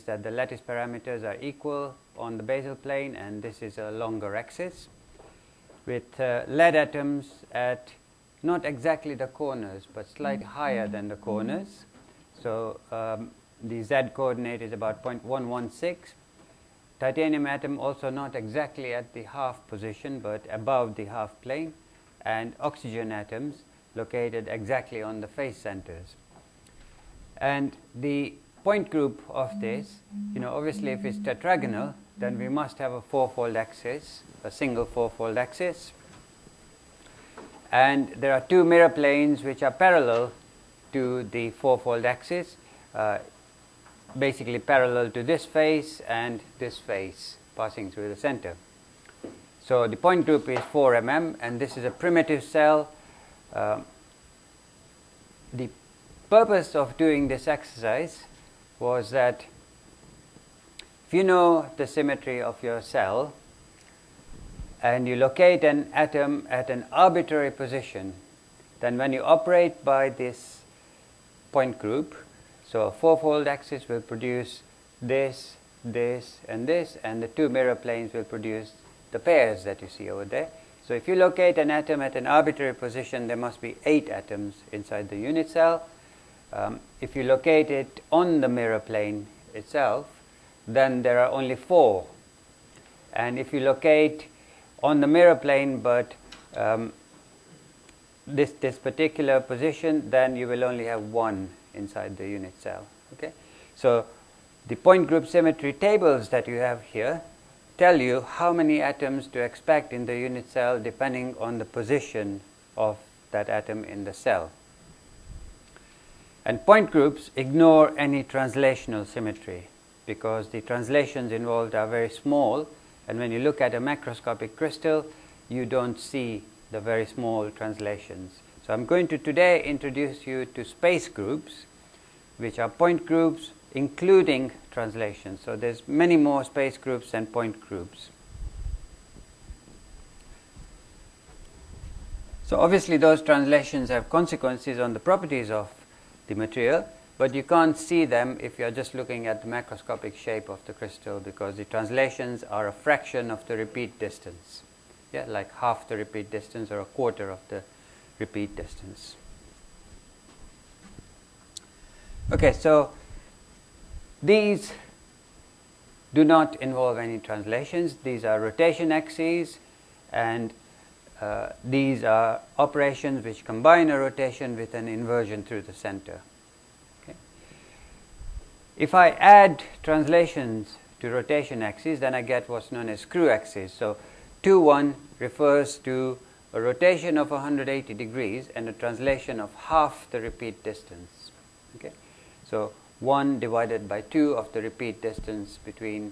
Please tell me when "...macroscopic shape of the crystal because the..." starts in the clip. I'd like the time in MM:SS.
02:29.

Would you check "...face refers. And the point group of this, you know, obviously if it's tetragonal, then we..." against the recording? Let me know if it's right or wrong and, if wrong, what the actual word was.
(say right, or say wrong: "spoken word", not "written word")
wrong: "centers", not "refers".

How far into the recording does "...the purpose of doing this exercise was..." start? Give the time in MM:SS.
00:55.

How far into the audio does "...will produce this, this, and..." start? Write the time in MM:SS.
01:13.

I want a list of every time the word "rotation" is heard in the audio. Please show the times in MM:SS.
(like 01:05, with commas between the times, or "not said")
02:48, 02:53, 03:01, 03:06.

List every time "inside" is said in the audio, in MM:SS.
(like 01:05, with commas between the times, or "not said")
01:24, 01:41.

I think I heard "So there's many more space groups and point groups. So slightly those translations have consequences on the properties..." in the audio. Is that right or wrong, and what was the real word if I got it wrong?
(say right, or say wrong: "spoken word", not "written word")
wrong: "obviously", not "slightly".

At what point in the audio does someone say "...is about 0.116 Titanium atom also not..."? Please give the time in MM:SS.
00:14.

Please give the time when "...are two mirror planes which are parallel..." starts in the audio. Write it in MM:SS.
00:38.